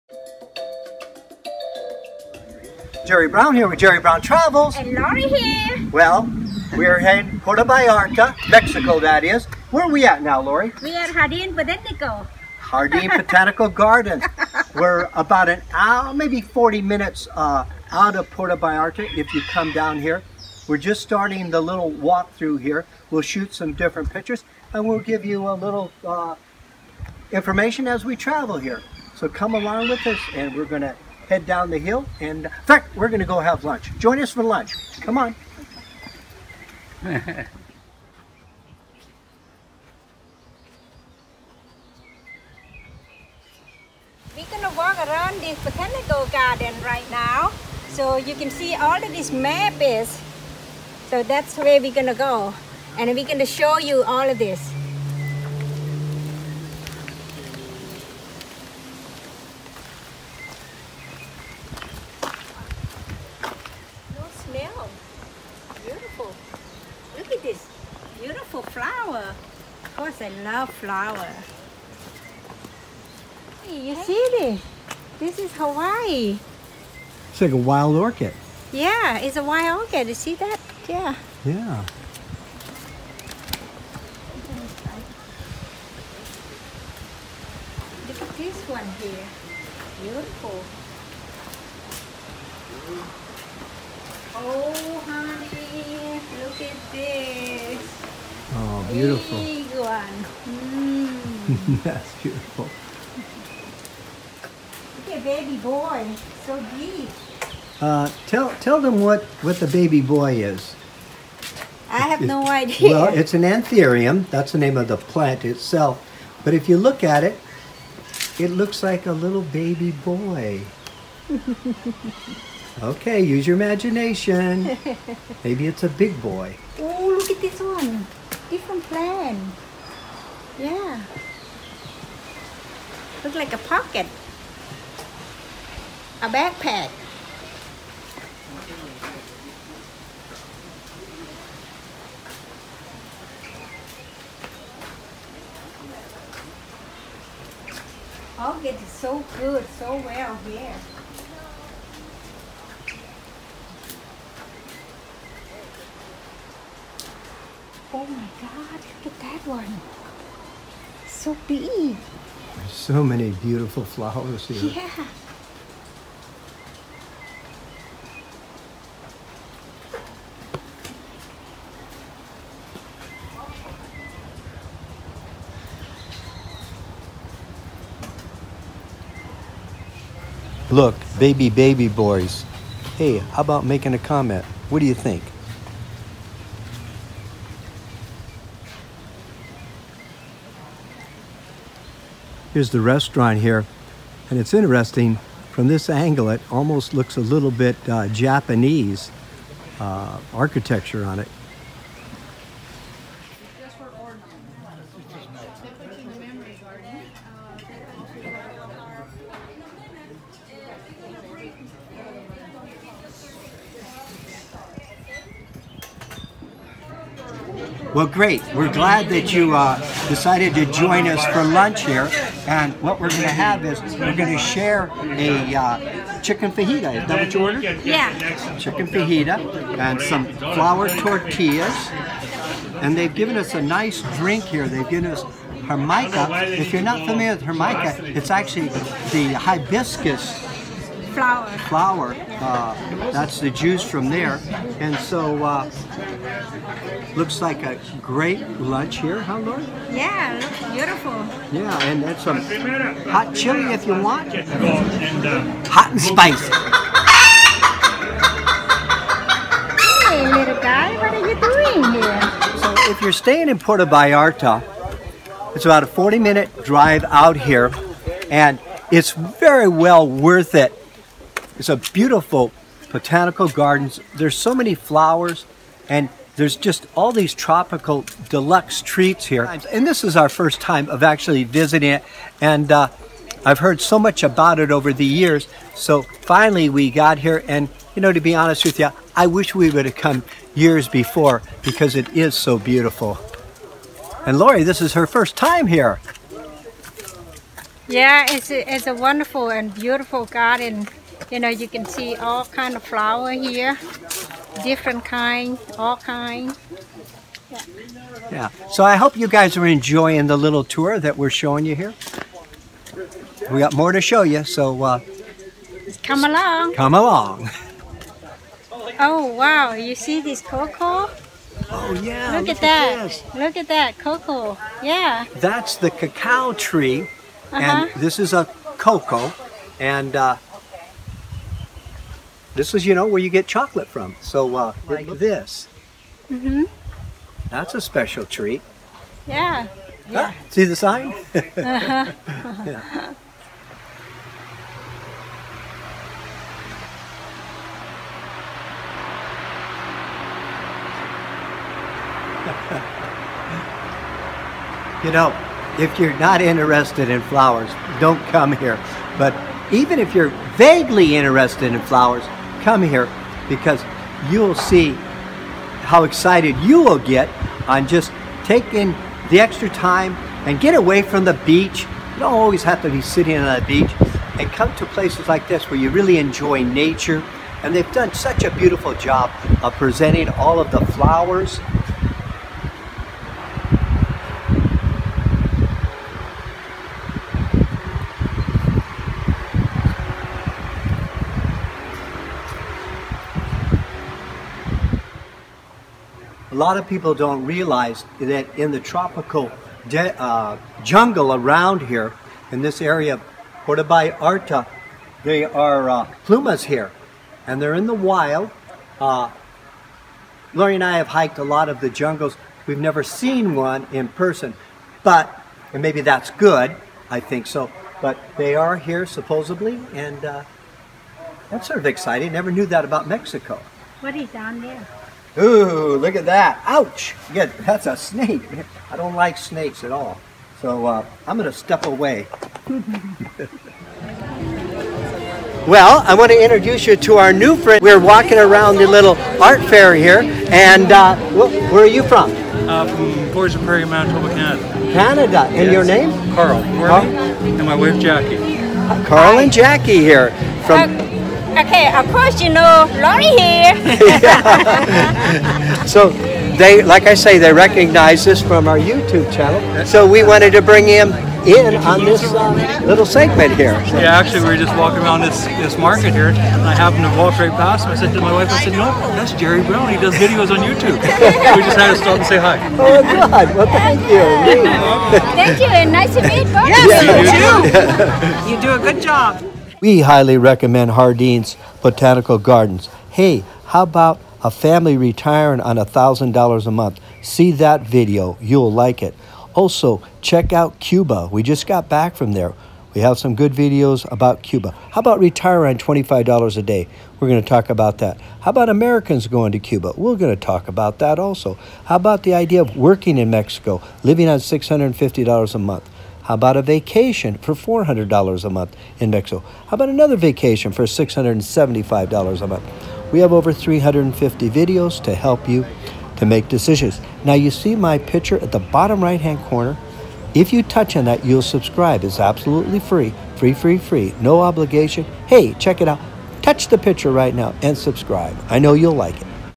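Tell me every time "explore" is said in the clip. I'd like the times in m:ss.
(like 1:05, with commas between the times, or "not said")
not said.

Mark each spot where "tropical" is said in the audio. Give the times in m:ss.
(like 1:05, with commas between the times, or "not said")
4:37, 6:38.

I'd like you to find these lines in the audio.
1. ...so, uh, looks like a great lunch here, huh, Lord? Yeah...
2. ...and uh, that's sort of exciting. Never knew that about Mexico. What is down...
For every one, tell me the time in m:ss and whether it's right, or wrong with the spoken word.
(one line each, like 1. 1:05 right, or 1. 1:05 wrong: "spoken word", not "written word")
1. 4:04 right
2. 6:59 right.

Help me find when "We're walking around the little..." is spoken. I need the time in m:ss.
7:17.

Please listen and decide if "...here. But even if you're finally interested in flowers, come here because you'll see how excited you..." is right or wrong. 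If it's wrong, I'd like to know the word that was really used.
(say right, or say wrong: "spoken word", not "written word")
wrong: "vaguely", not "finally".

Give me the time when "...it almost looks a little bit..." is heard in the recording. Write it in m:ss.
3:16.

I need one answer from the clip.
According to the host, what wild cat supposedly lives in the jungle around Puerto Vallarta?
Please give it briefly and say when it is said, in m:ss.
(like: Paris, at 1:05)
Pumas, at 6:46.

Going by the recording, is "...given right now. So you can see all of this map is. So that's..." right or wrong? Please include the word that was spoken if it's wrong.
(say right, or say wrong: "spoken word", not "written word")
wrong: "garden", not "given".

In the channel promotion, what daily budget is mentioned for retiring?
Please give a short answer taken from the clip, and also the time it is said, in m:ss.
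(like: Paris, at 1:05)
$25 a day, at 8:15.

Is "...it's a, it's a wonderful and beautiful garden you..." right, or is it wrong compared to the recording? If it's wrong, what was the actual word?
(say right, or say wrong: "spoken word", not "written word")
right.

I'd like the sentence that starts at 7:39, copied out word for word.
So we wanted to bring him in on this uh, little segment here.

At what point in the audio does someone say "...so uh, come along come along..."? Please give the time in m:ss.
5:14.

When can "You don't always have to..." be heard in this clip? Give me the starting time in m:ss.
6:12.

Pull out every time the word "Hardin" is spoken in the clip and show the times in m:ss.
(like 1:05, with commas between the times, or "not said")
8:00.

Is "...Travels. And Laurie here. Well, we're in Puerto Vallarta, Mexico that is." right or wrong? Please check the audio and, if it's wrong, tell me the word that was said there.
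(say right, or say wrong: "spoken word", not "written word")
right.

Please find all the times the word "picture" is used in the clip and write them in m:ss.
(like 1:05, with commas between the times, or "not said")
0:24, 8:37, 8:46.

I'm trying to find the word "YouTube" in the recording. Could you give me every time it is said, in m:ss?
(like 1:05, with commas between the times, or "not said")
7:38, 7:50.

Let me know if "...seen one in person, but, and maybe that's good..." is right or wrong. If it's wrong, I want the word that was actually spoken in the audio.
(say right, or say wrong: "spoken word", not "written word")
right.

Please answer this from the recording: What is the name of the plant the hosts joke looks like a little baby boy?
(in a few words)
Anthurium.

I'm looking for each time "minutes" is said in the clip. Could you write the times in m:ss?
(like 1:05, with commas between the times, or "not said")
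0:16, 4:26.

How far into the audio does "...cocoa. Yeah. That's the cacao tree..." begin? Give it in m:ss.
5:23.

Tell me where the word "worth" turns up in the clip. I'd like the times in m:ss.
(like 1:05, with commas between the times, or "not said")
4:30.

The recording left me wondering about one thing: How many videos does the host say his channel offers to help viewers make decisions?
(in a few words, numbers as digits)
Over 350.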